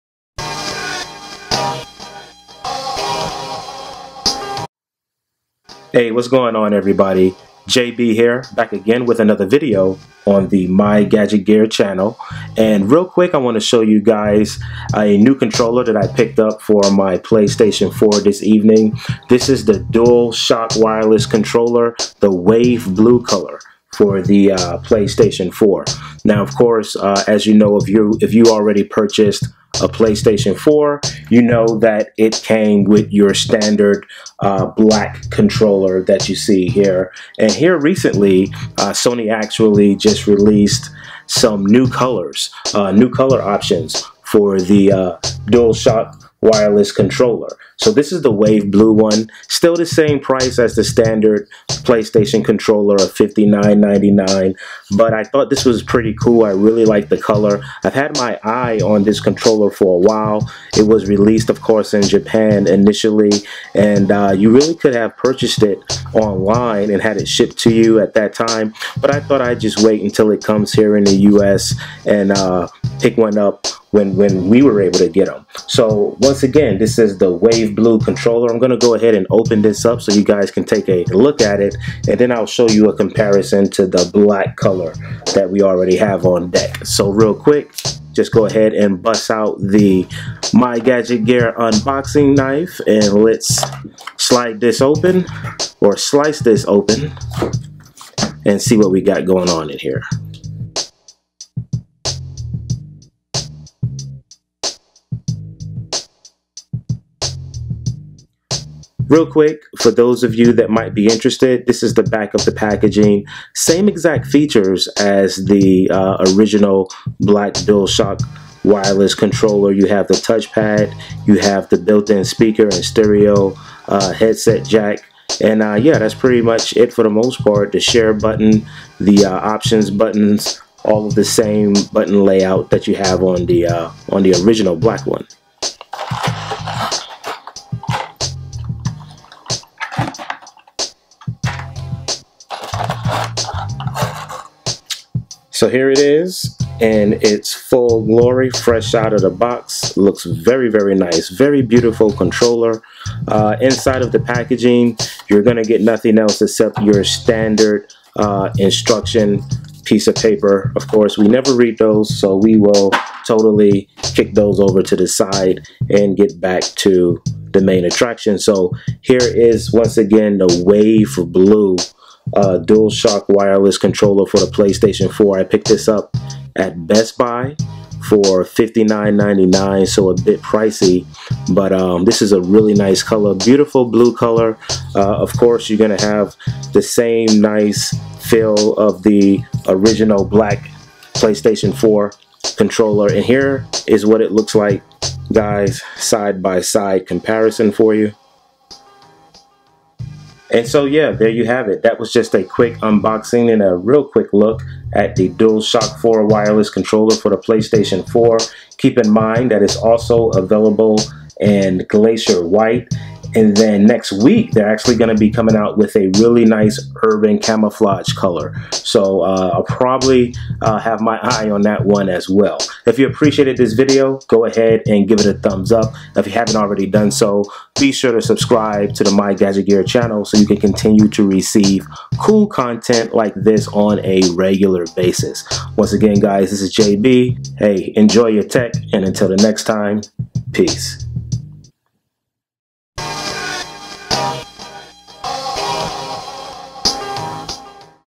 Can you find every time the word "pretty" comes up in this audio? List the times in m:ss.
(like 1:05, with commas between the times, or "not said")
0:55, 2:06.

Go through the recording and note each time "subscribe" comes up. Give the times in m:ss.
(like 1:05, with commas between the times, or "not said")
3:48.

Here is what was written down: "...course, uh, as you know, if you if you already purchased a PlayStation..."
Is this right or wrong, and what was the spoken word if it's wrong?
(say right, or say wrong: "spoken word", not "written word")
right.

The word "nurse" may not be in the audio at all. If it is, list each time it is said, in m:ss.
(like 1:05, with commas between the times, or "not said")
not said.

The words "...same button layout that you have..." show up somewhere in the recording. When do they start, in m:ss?
2:11.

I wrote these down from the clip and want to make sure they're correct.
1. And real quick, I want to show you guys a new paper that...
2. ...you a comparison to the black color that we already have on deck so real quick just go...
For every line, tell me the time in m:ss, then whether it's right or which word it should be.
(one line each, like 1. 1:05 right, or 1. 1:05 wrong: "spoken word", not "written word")
1. 0:12 wrong: "controller", not "paper"
2. 1:22 right.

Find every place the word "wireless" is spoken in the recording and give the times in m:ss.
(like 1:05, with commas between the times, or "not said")
0:20, 0:46, 1:58, 2:53, 3:26.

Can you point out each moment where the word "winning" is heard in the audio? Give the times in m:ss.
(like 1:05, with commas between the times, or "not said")
not said.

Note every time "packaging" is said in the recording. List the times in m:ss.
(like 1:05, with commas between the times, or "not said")
1:52, 2:34.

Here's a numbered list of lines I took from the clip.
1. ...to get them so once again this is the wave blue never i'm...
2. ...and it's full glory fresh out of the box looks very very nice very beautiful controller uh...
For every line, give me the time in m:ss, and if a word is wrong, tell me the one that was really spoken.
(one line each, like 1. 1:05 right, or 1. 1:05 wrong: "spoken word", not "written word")
1. 1:14 wrong: "controller", not "never"
2. 2:26 right.